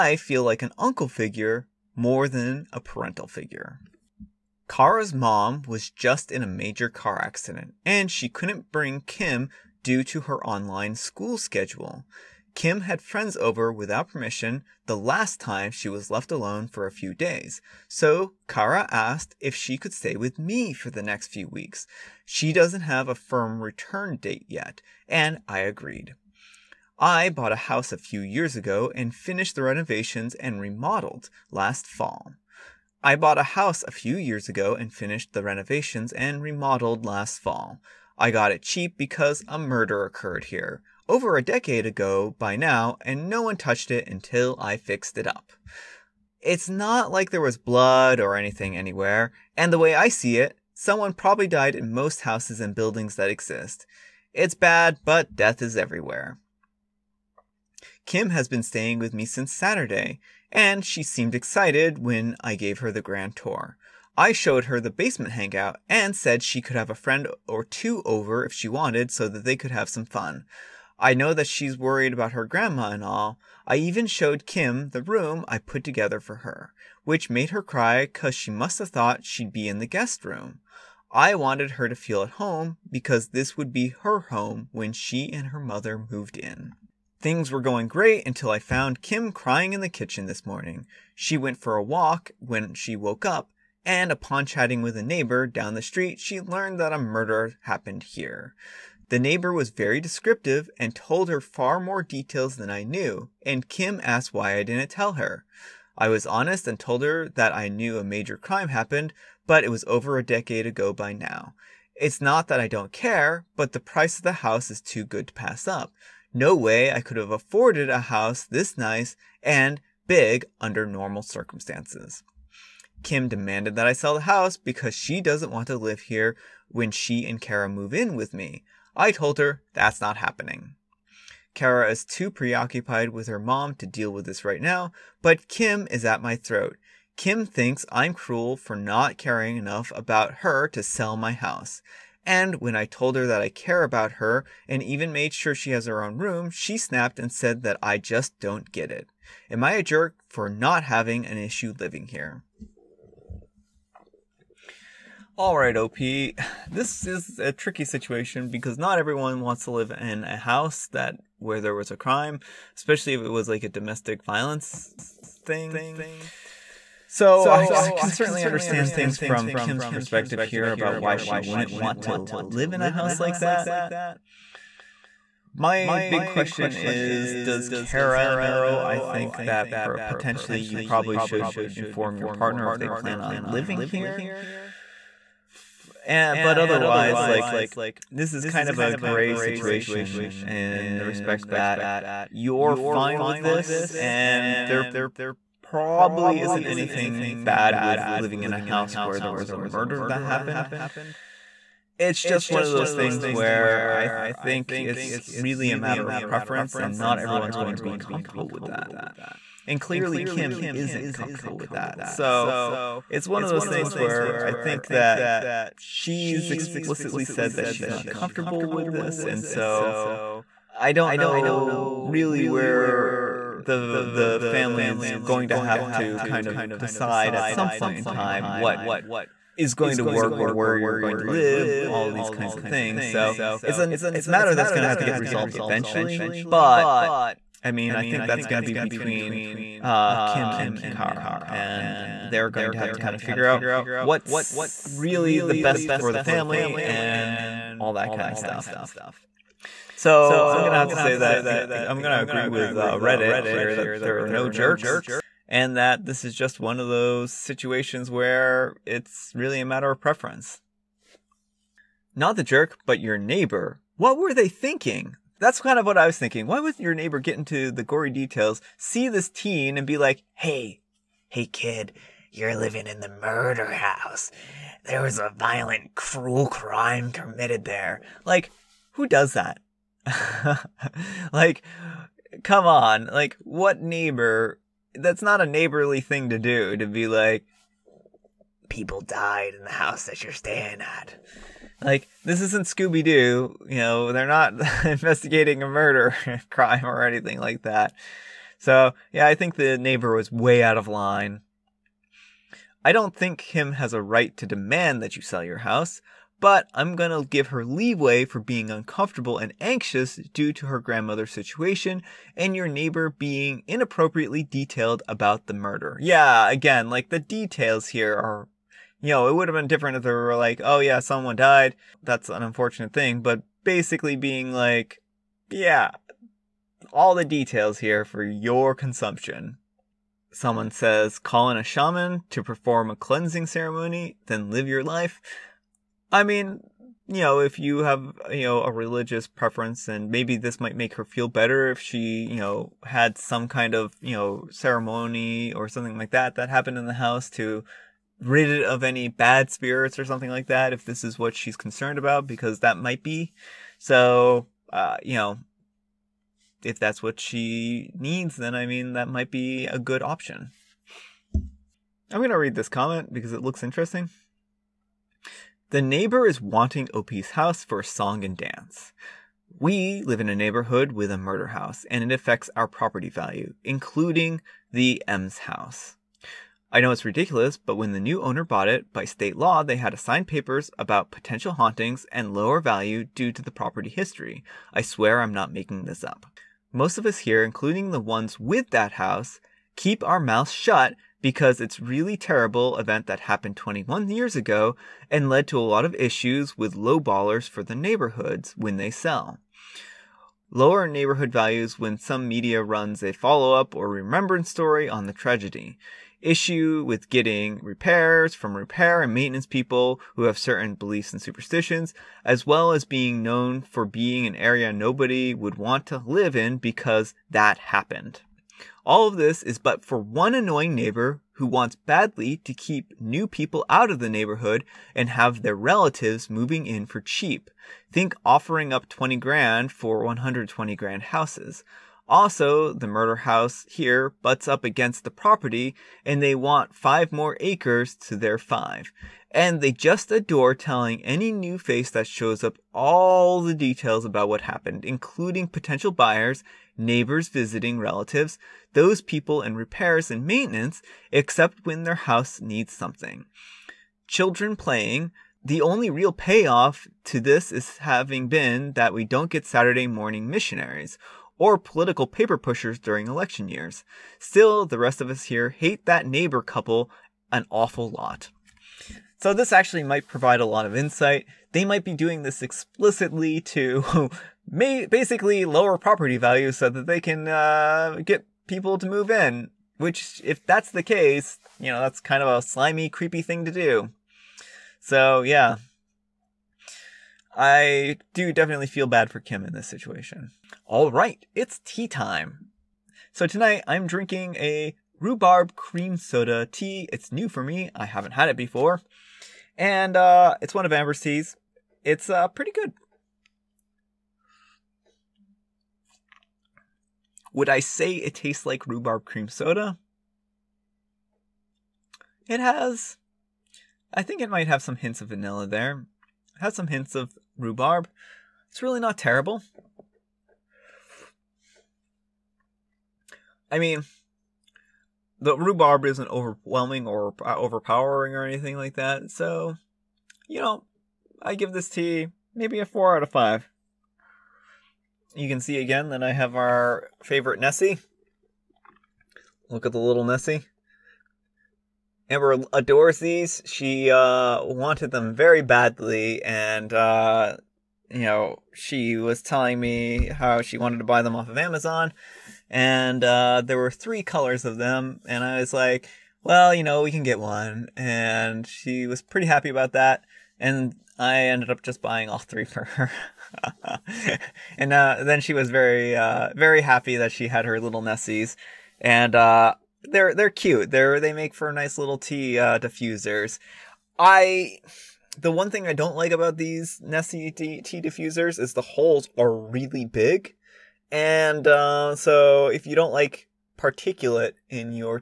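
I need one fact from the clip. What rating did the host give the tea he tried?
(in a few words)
4 out of 5.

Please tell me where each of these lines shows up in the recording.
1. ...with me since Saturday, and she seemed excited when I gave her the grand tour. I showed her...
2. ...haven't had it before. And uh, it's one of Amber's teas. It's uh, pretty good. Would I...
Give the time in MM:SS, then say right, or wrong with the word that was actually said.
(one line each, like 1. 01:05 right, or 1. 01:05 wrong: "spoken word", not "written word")
1. 00:58 right
2. 08:17 right.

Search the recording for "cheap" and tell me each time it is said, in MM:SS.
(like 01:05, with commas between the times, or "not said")
00:38, 07:07.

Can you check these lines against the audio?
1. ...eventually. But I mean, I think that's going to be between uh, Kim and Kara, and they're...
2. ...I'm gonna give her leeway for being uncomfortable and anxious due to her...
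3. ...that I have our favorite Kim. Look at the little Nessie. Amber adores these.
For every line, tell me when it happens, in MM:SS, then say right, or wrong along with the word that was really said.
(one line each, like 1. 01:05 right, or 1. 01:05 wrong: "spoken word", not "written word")
1. 03:55 right
2. 05:06 right
3. 08:55 wrong: "Nessie", not "Kim".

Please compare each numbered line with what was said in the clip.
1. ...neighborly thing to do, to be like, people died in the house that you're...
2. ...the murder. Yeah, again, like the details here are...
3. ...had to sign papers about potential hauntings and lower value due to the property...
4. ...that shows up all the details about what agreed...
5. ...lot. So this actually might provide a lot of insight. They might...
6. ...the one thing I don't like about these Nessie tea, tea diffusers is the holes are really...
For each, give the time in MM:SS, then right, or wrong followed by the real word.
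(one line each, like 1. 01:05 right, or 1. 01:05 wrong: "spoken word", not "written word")
1. 04:45 right
2. 05:15 right
3. 06:19 right
4. 07:21 wrong: "happened", not "agreed"
5. 07:47 right
6. 09:35 right.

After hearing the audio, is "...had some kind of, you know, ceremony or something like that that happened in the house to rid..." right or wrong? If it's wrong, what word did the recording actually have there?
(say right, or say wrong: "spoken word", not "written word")
right.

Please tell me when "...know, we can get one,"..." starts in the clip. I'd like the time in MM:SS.
09:16.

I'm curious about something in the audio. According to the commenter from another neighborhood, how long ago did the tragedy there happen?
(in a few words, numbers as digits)
21 years.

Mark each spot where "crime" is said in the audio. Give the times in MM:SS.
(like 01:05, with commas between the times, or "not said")
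01:48, 02:41, 04:36, 04:56.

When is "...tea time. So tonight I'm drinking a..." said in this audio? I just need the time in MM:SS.
08:11.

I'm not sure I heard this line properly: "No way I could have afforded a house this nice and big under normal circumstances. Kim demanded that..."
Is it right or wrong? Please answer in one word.
right.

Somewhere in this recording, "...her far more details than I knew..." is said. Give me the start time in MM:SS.
01:41.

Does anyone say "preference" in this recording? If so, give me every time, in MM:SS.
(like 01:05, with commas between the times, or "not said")
03:26, 04:19, 05:39.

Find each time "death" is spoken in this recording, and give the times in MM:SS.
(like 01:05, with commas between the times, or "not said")
00:55.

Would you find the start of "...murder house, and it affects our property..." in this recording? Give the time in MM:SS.
06:11.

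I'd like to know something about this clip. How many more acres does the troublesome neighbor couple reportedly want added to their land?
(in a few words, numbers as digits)
5 acres.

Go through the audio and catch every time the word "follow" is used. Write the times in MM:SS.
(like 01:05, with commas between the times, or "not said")
06:43.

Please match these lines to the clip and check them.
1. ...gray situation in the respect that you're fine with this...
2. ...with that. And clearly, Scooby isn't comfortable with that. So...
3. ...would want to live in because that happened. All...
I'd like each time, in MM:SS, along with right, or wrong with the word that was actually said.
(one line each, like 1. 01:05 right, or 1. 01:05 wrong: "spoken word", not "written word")
1. 03:08 right
2. 03:28 wrong: "Kim", not "Scooby"
3. 06:55 right.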